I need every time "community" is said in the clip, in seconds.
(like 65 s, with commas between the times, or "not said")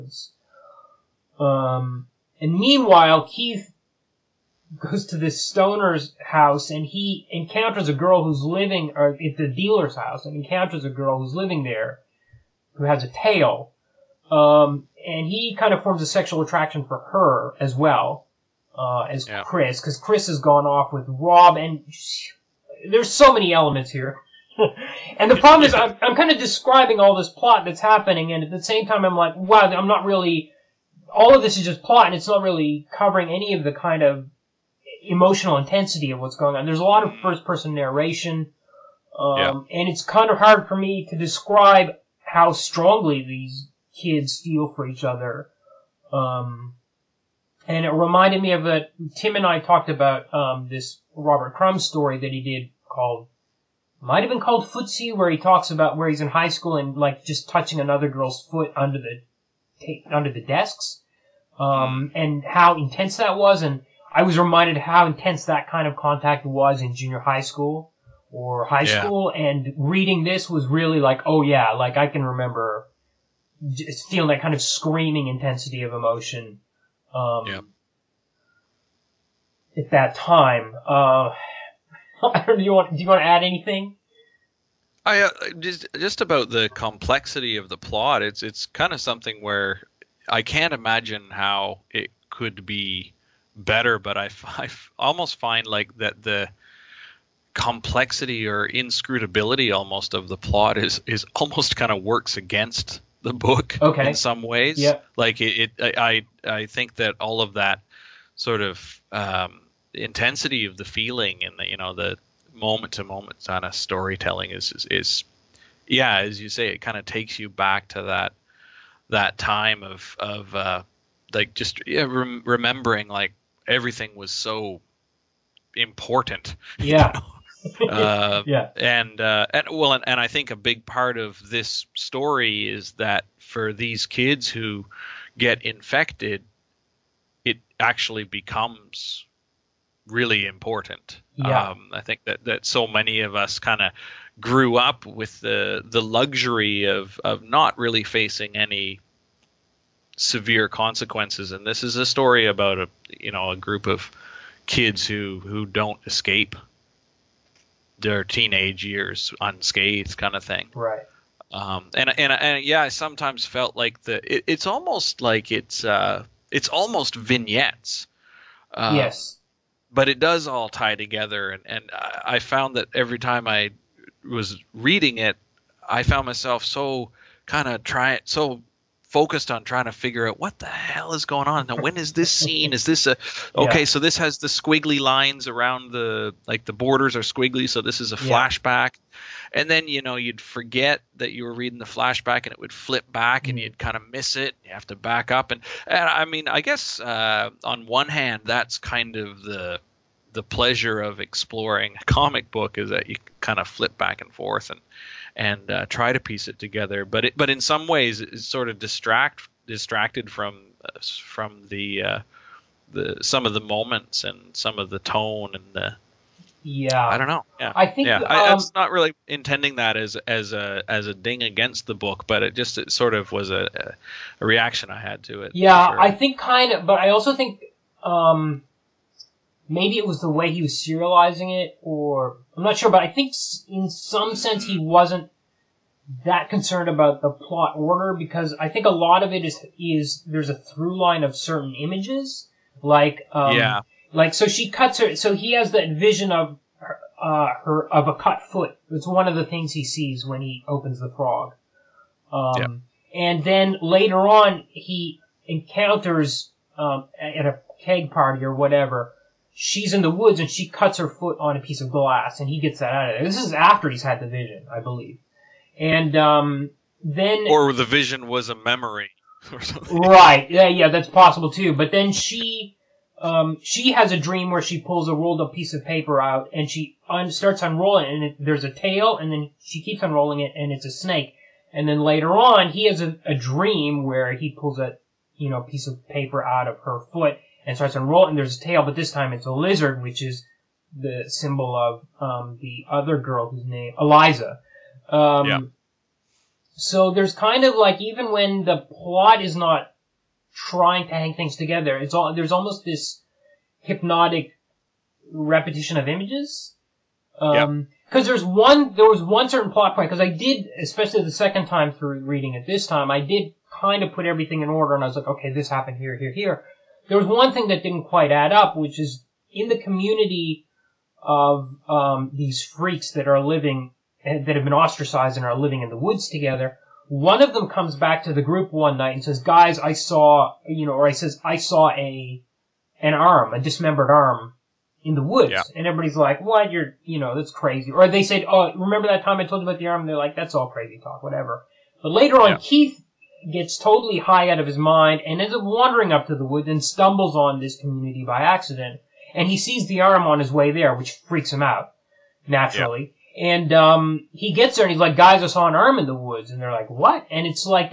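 319 s, 347 s.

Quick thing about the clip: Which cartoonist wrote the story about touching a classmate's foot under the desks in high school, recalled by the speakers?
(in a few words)
Robert Crumb.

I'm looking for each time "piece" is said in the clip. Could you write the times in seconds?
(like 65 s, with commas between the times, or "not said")
206 s, 261 s, 275 s, 285 s.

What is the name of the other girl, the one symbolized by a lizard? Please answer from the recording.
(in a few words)
Eliza.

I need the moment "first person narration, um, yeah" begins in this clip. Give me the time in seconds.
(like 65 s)
37 s.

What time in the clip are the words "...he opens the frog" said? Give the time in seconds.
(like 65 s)
250 s.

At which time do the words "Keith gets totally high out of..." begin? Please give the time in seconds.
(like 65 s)
342 s.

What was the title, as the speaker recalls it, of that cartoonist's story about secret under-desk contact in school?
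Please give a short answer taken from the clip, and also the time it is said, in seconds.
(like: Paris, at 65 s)
Footsie, at 54 s.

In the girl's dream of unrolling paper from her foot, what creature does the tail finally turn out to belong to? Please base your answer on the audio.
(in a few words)
a snake.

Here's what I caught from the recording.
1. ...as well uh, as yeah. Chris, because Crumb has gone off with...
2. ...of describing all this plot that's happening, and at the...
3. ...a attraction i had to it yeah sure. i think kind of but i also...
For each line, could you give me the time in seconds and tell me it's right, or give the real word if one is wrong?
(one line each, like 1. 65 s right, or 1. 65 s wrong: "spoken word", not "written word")
1. 17 s wrong: "Chris", not "Crumb"
2. 26 s right
3. 224 s wrong: "reaction", not "attraction".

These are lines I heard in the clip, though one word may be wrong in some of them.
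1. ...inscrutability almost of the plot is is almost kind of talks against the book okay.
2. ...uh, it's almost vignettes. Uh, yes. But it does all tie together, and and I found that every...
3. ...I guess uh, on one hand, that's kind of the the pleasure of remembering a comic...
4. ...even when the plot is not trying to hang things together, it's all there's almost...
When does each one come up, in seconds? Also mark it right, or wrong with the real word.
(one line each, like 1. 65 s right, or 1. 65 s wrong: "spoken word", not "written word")
1. 98 s wrong: "works", not "talks"
2. 165 s right
3. 196 s wrong: "exploring", not "remembering"
4. 298 s right.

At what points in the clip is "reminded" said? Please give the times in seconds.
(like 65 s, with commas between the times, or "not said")
47 s, 64 s.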